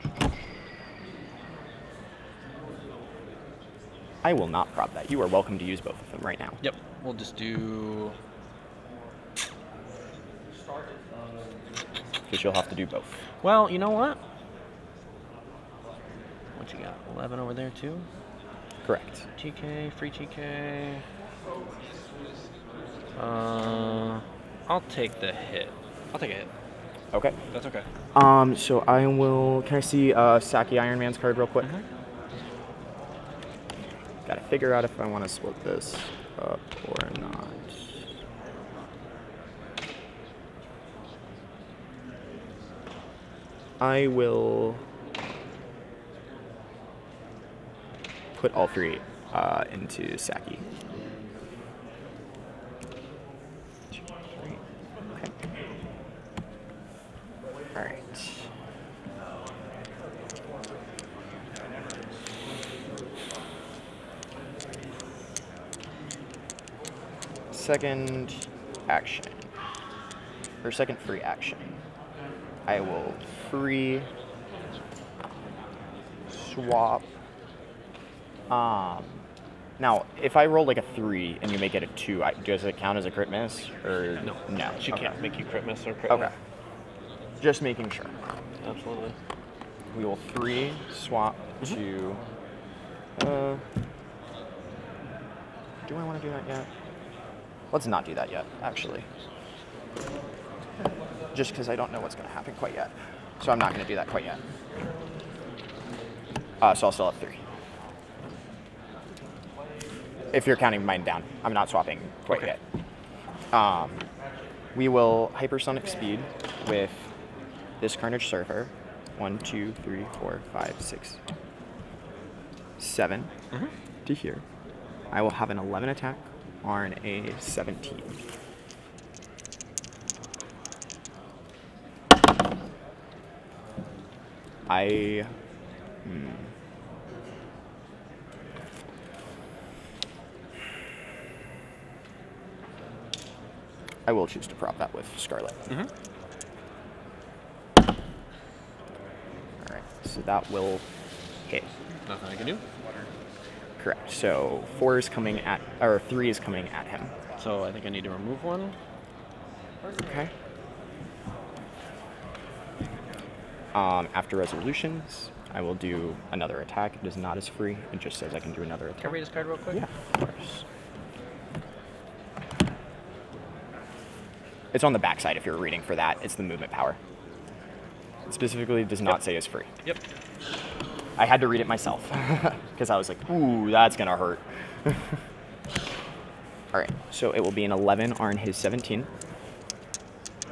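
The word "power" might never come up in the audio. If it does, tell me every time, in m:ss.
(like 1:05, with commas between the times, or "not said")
2:56.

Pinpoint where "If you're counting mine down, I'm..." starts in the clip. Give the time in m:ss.
1:50.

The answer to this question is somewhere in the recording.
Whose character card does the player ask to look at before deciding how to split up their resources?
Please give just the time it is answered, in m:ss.
0:30.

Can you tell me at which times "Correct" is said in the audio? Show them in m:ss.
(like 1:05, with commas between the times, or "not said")
0:18, 2:33.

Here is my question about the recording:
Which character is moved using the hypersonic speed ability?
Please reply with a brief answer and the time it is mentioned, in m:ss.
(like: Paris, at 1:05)
Carnage Surfer, at 1:57.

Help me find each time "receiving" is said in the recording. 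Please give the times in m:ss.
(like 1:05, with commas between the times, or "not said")
not said.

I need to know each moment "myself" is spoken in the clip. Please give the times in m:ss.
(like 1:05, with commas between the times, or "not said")
3:01.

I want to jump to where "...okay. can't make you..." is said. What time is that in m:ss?
1:24.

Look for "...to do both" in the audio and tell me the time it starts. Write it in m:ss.
0:12.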